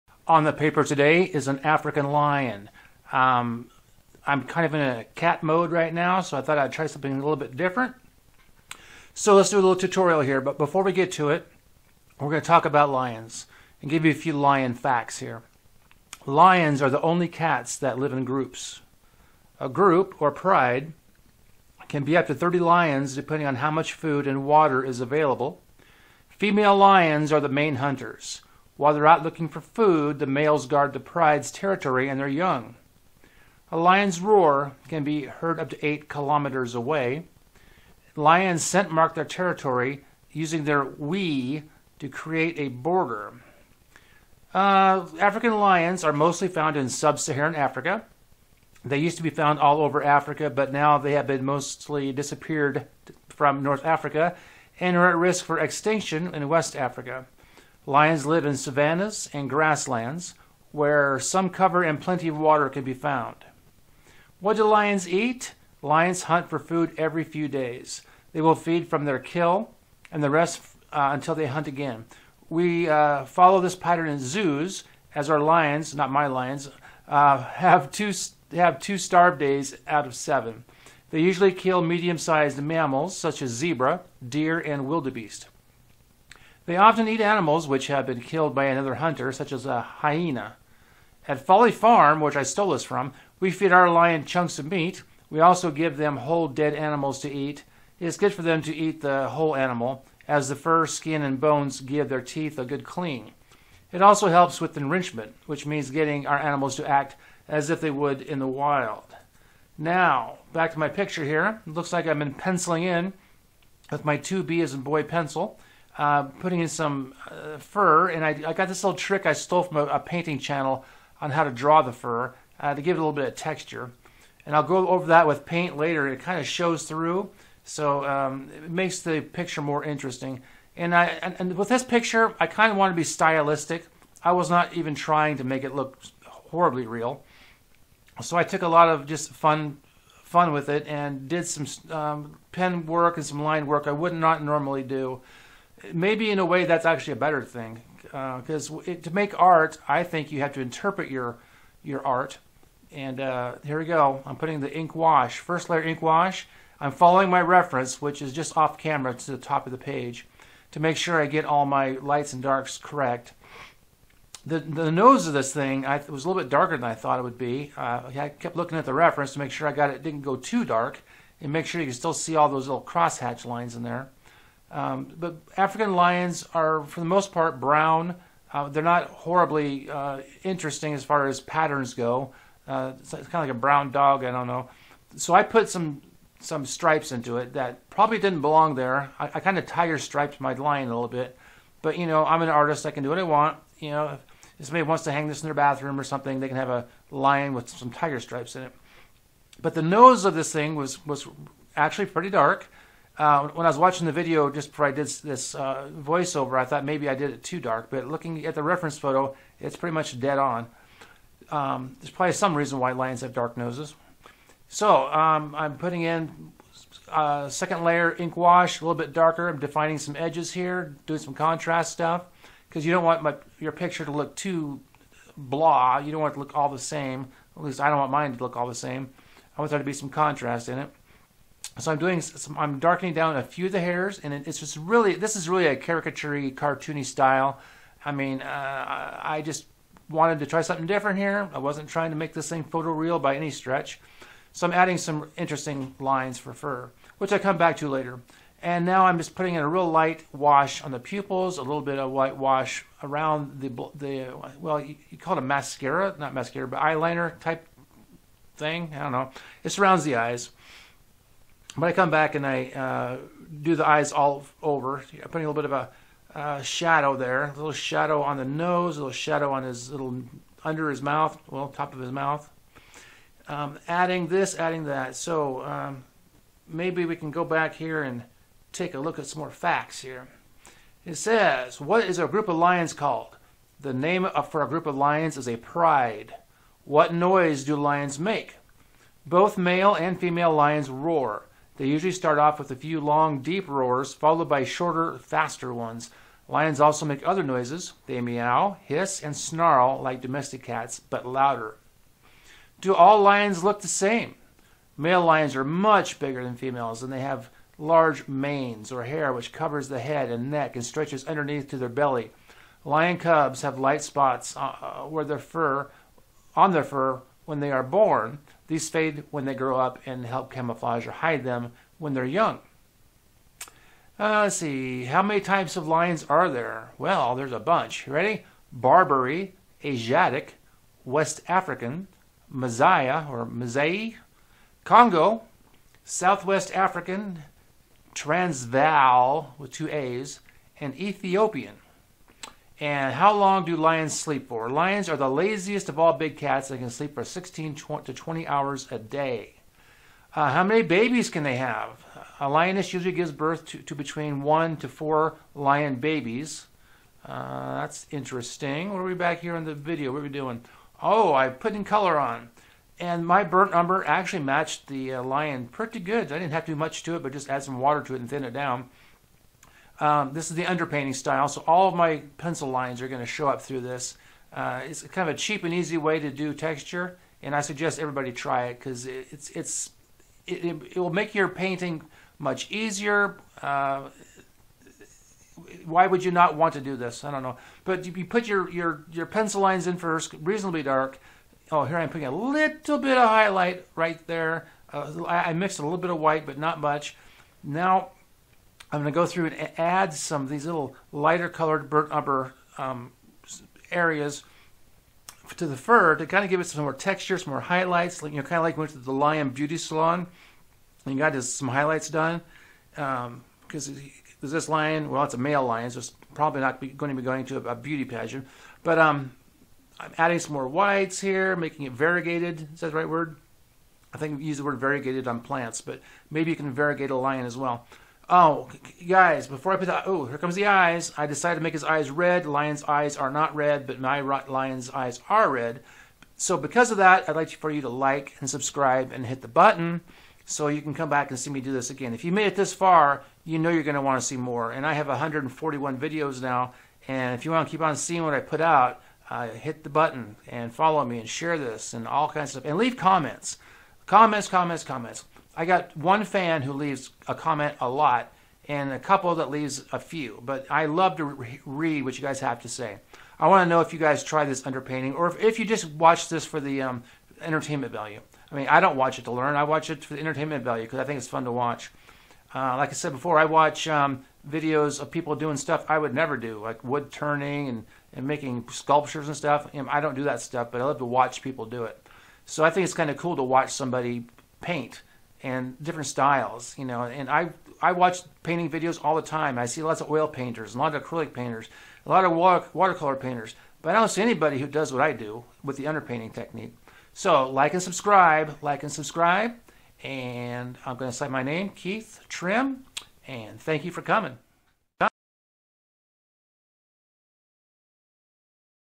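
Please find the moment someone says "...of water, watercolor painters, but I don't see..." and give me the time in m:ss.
8:12.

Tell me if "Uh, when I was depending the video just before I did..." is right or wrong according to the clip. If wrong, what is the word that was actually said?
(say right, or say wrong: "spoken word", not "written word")
wrong: "watching", not "depending".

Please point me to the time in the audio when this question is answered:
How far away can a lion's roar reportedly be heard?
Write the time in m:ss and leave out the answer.
0:35.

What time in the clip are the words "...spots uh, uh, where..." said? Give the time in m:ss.
5:14.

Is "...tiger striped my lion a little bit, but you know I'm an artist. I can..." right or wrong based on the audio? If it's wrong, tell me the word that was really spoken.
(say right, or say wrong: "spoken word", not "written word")
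right.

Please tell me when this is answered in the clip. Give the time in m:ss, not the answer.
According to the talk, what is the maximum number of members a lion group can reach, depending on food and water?
0:22.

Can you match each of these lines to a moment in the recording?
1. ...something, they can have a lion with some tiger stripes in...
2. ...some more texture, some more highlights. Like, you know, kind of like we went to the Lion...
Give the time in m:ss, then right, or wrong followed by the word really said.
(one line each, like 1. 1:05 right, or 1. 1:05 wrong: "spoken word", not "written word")
1. 3:16 right
2. 6:46 right.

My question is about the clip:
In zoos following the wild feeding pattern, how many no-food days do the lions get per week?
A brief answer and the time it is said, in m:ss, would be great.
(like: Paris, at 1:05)
2, at 1:18.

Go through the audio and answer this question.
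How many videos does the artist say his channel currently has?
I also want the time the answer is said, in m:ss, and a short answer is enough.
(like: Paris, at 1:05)
141, at 7:25.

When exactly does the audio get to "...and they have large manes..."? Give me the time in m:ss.
5:07.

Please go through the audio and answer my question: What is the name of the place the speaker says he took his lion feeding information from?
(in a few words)
Folly Farm.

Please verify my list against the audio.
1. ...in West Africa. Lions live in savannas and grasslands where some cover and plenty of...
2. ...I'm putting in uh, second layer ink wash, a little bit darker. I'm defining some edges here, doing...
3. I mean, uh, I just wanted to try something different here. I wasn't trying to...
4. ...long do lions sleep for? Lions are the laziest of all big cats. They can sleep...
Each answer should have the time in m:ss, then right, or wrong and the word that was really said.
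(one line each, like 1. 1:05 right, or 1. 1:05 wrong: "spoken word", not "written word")
1. 0:56 right
2. 3:35 right
3. 3:58 right
4. 5:43 right.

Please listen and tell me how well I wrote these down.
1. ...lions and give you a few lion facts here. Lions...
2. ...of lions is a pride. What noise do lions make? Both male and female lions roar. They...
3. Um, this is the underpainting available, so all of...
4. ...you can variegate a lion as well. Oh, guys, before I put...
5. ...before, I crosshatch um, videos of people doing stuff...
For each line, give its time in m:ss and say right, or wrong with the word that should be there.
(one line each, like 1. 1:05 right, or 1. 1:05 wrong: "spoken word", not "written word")
1. 0:12 right
2. 4:44 right
3. 6:10 wrong: "style", not "available"
4. 7:06 right
5. 7:53 wrong: "watch", not "crosshatch".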